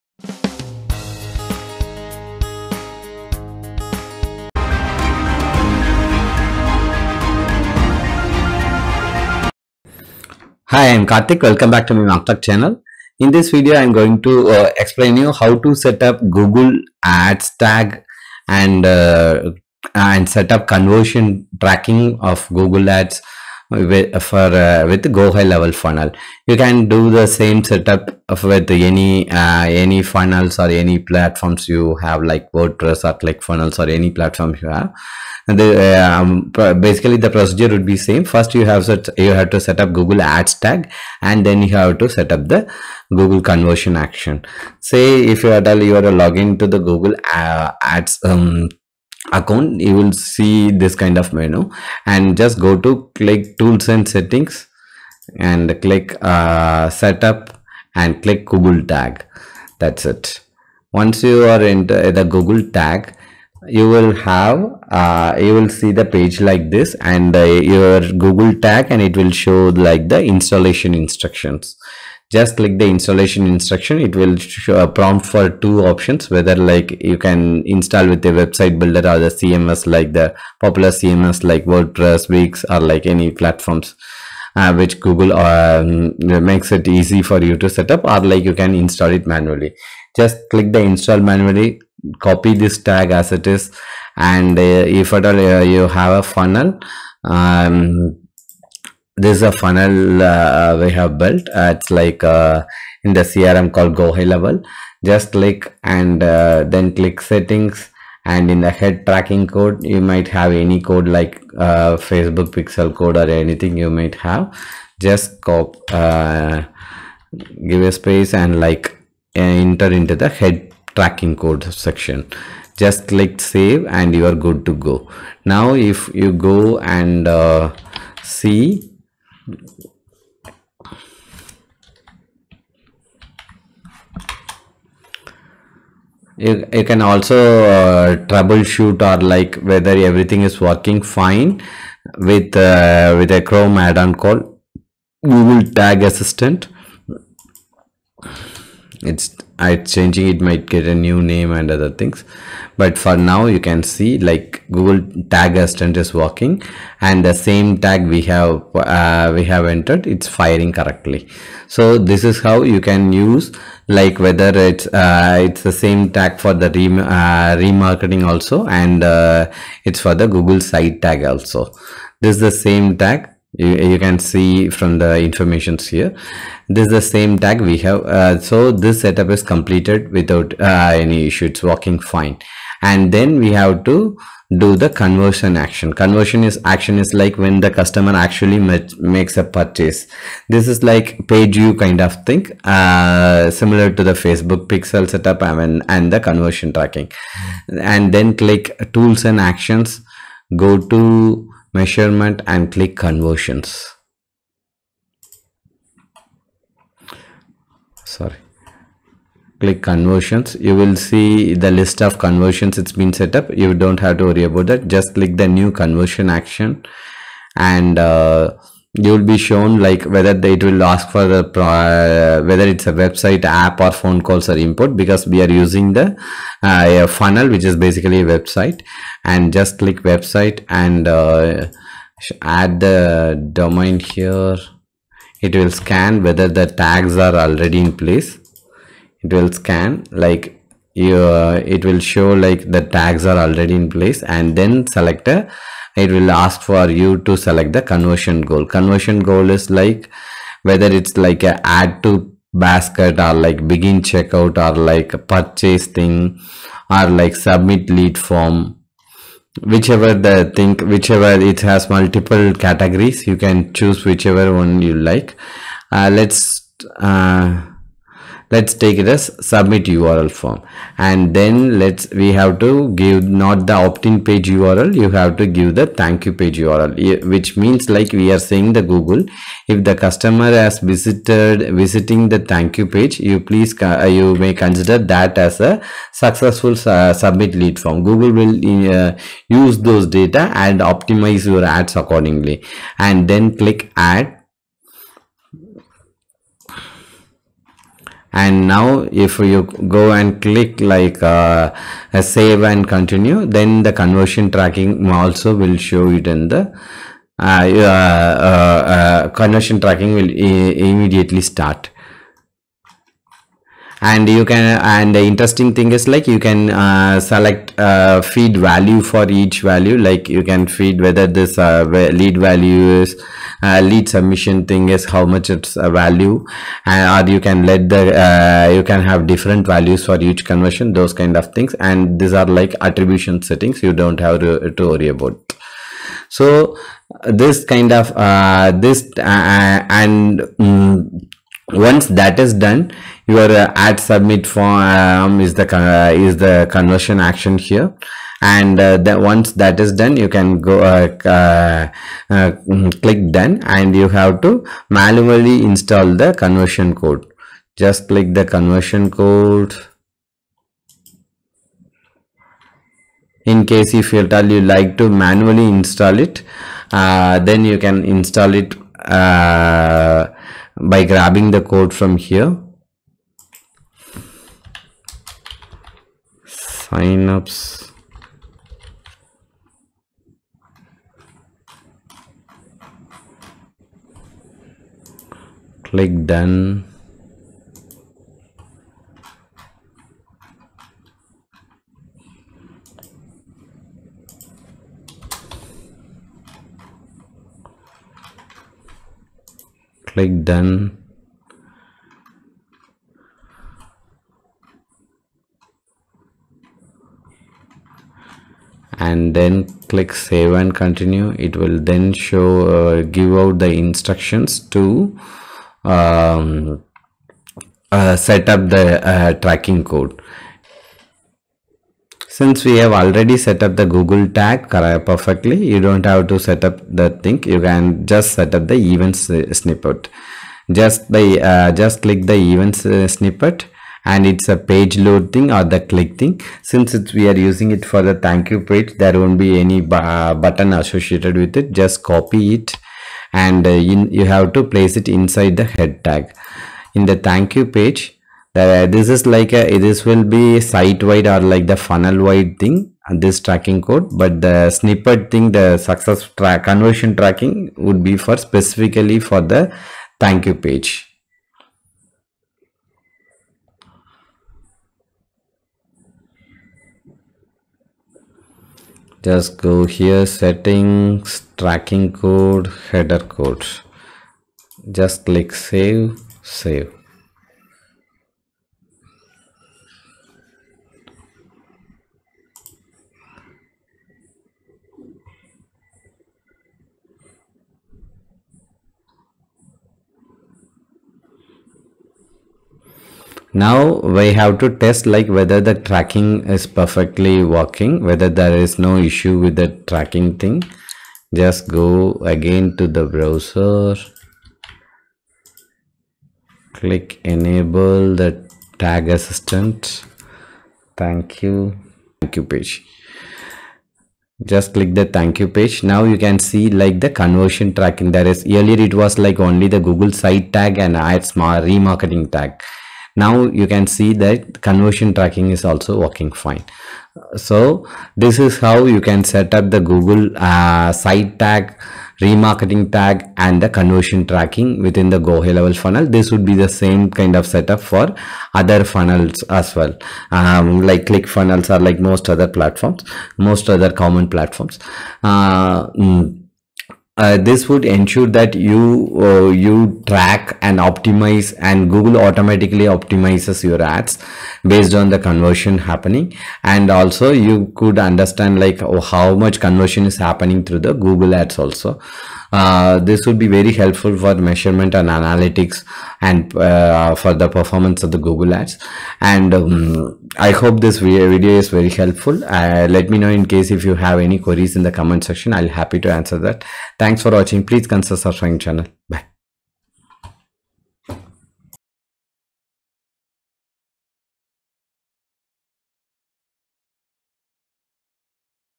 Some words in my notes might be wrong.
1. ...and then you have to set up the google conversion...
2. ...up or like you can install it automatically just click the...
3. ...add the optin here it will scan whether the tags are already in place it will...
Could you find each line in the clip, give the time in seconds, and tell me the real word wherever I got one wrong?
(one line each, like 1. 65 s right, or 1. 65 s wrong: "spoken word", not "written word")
1. 41 s right
2. 87 s wrong: "manually", not "automatically"
3. 232 s wrong: "domain", not "optin".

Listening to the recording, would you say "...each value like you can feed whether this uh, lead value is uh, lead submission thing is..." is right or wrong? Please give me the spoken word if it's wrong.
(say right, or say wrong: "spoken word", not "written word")
right.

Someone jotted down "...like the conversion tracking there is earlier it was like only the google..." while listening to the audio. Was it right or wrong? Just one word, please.
right.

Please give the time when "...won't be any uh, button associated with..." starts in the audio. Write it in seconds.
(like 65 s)
439 s.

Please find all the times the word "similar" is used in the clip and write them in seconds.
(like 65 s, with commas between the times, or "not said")
193 s.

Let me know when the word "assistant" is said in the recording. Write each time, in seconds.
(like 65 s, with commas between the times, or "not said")
146 s, 155 s, 509 s.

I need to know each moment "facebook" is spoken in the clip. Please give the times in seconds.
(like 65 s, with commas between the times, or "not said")
111 s, 194 s.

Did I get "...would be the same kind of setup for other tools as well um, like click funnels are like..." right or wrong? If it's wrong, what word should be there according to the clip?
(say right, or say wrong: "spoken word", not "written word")
wrong: "funnels", not "tools".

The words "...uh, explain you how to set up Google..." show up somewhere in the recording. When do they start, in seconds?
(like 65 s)
14 s.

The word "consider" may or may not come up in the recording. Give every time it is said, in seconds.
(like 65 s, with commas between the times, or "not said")
284 s, 577 s.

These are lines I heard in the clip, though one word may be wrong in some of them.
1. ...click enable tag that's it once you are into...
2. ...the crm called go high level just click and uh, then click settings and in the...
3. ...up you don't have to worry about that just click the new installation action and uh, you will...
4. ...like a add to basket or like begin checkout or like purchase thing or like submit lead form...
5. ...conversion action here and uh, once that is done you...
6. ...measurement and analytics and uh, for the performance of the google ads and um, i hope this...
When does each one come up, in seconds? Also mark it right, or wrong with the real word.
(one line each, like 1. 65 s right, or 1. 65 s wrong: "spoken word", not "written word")
1. 58 s wrong: "google", not "enable"
2. 103 s right
3. 213 s wrong: "conversion", not "installation"
4. 251 s right
5. 346 s right
6. 564 s right.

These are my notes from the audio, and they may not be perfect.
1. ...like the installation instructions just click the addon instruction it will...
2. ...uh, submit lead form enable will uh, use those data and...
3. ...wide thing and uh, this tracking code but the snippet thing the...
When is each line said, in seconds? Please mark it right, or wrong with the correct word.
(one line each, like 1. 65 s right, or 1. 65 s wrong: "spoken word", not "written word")
1. 69 s wrong: "installation", not "addon"
2. 286 s wrong: "google", not "enable"
3. 452 s right.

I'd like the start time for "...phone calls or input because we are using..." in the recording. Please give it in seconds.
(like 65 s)
223 s.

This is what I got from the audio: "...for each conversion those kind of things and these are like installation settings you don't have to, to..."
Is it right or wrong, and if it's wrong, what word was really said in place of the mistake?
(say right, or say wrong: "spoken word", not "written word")
wrong: "attribution", not "installation".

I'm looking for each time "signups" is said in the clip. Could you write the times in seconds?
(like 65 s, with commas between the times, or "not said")
376 s.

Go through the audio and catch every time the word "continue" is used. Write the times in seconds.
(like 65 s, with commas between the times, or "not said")
302 s, 410 s.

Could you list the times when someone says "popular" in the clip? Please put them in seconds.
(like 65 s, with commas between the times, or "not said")
80 s.